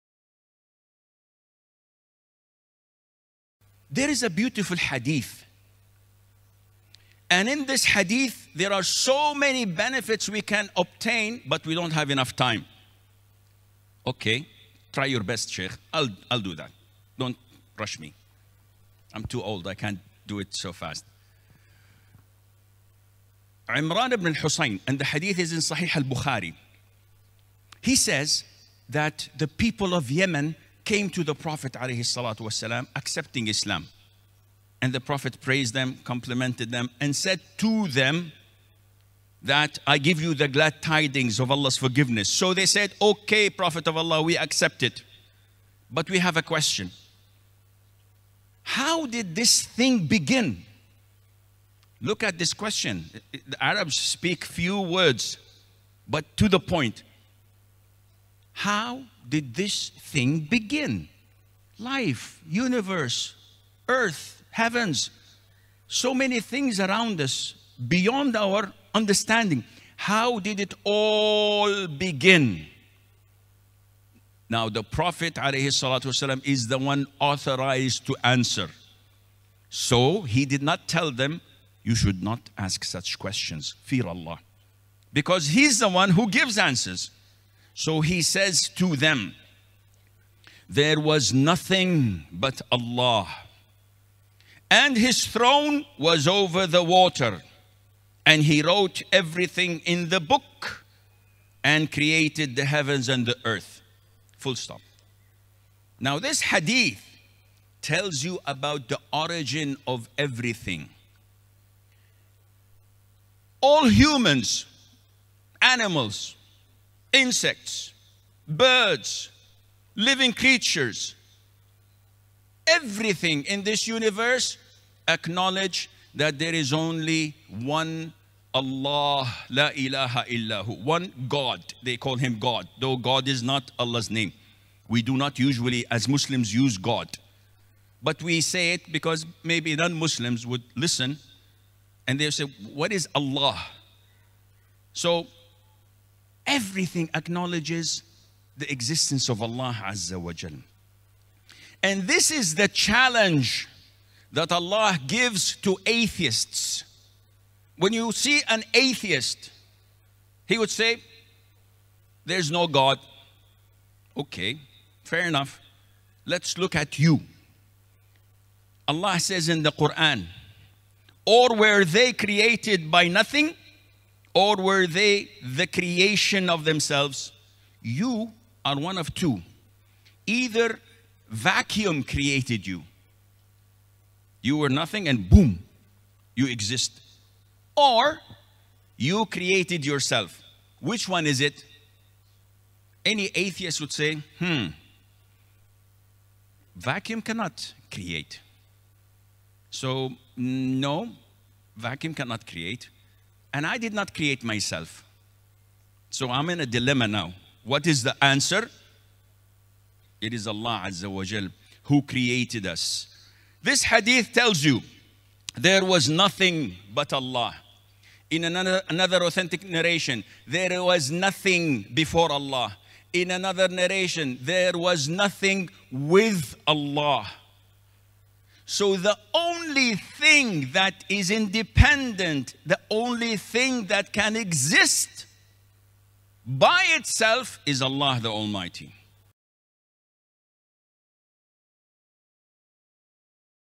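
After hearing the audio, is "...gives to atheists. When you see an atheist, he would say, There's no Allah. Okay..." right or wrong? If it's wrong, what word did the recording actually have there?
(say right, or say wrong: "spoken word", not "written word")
wrong: "God", not "Allah".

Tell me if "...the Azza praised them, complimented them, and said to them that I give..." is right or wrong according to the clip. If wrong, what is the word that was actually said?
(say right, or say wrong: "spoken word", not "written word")
wrong: "Prophet", not "Azza".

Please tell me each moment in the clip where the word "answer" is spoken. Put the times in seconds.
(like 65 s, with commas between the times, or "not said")
78 s, 86 s, 208 s.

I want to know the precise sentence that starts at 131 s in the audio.
They call him God, though God is not Allah's name.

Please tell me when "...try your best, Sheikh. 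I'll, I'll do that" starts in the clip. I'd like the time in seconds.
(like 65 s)
14 s.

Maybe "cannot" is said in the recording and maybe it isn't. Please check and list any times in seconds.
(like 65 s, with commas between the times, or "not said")
197 s, 202 s.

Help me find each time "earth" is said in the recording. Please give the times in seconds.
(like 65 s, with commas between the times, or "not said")
63 s, 103 s.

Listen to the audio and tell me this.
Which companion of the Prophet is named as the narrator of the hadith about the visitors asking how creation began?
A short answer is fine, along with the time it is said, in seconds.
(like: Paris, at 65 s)
Imran ibn Hussein, at 23 s.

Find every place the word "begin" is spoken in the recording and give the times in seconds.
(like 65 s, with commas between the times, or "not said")
50 s, 60 s, 71 s.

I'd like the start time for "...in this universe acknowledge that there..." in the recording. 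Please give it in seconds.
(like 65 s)
123 s.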